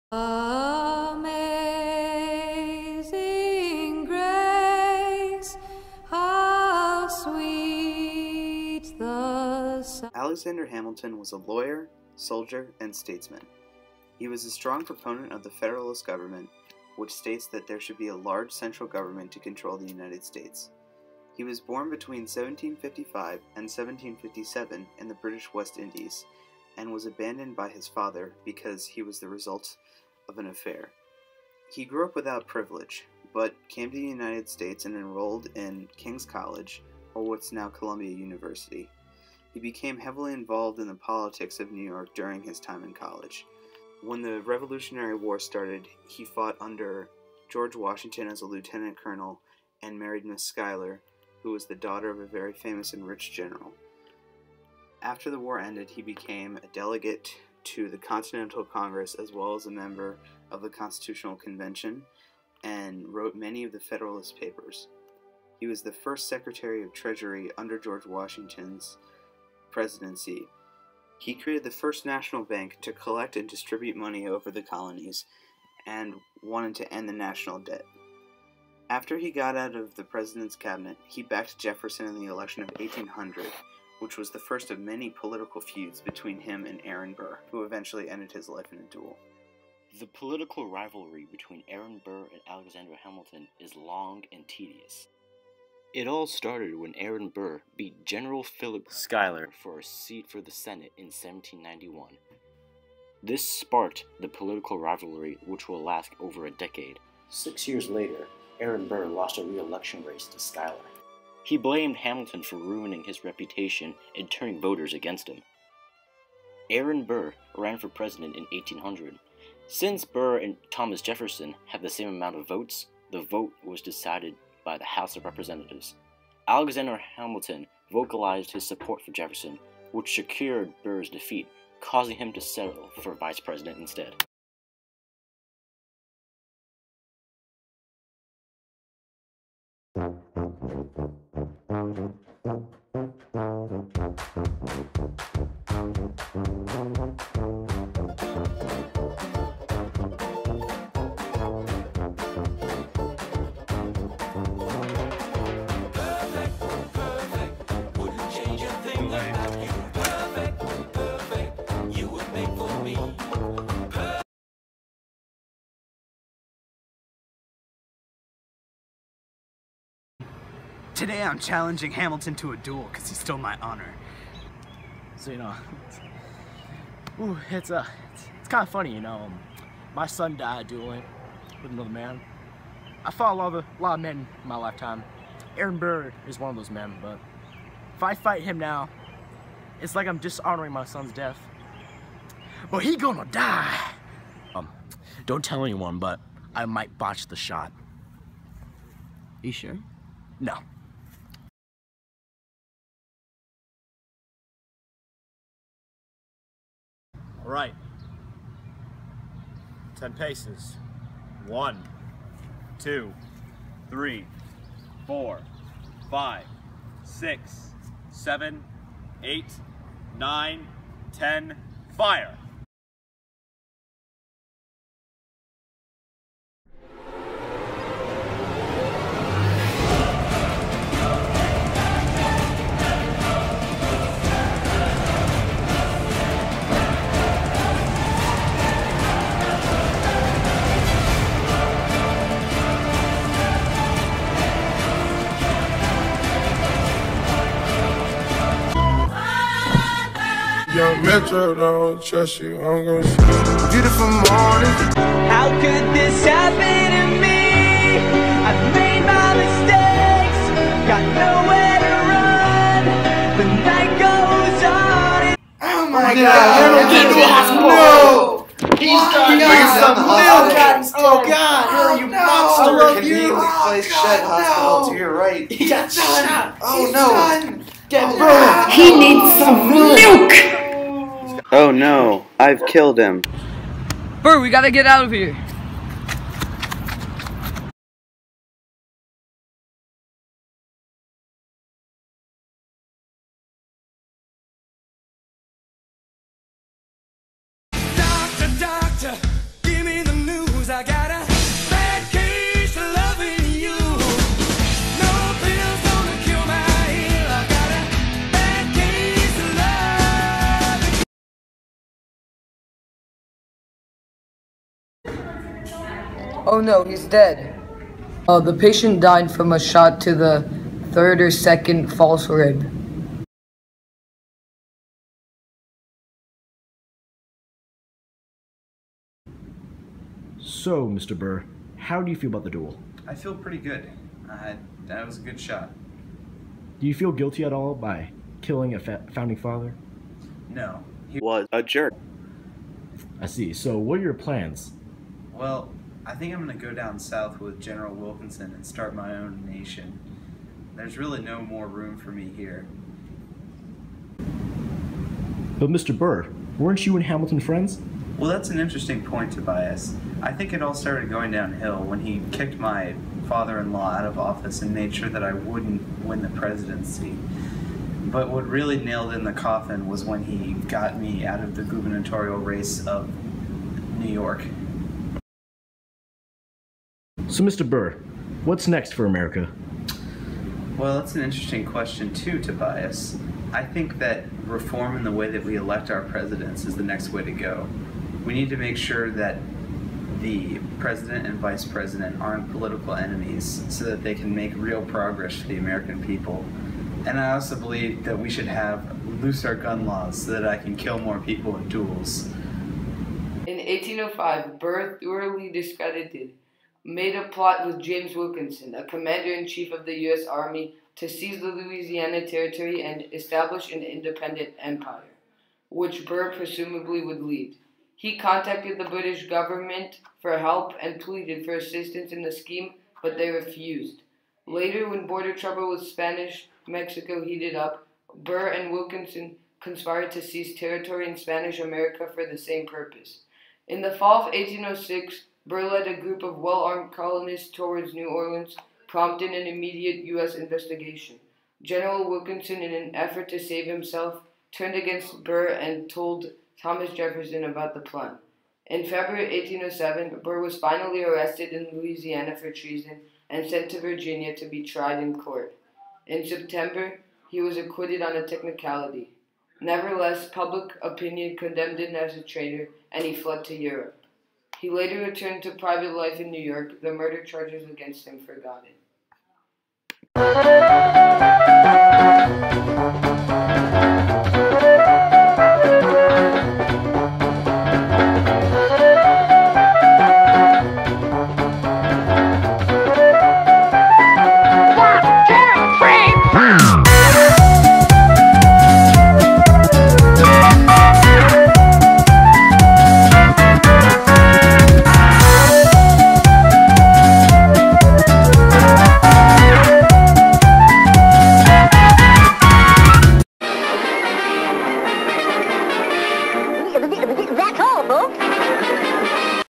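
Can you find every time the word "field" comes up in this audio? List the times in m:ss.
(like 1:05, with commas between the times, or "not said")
not said.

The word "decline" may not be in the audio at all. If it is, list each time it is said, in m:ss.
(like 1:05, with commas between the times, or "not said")
not said.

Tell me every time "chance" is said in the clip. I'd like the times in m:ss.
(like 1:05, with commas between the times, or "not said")
not said.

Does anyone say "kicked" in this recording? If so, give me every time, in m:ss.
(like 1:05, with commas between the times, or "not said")
6:02.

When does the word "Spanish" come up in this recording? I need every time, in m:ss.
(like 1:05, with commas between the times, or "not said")
7:05, 7:11.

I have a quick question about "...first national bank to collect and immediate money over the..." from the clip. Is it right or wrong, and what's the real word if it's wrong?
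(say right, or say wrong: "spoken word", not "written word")
wrong: "distribute", not "immediate".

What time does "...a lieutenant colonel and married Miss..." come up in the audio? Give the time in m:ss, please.
0:48.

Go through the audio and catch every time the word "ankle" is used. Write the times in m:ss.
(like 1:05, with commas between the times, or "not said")
not said.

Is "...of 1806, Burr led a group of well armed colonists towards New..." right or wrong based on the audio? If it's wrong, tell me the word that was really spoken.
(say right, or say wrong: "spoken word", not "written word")
right.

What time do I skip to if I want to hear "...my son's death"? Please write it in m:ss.
3:10.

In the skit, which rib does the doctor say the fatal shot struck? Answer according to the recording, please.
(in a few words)
Third or second false rib.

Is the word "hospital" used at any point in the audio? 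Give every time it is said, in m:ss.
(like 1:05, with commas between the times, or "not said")
4:27, 4:33.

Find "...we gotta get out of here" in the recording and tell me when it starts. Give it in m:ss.
4:44.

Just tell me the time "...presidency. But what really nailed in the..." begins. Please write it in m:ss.
6:06.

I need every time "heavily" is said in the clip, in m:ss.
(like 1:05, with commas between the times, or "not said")
0:39.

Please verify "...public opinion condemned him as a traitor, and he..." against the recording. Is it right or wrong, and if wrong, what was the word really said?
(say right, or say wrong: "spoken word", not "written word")
right.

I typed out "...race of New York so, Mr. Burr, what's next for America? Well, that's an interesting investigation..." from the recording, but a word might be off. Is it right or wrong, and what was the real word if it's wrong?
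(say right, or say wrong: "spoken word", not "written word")
wrong: "question", not "investigation".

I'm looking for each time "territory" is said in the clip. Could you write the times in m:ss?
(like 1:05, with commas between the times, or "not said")
6:52, 7:10.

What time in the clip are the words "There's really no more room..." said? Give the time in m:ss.
5:50.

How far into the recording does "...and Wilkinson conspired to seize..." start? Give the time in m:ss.
7:08.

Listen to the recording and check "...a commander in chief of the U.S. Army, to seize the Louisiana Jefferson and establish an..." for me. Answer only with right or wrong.
wrong.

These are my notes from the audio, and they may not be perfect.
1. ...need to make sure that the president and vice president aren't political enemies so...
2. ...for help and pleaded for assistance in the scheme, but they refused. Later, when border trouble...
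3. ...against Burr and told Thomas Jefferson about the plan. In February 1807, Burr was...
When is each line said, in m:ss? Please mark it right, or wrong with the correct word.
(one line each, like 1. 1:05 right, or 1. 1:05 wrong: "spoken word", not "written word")
1. 6:28 right
2. 7:00 right
3. 7:24 right.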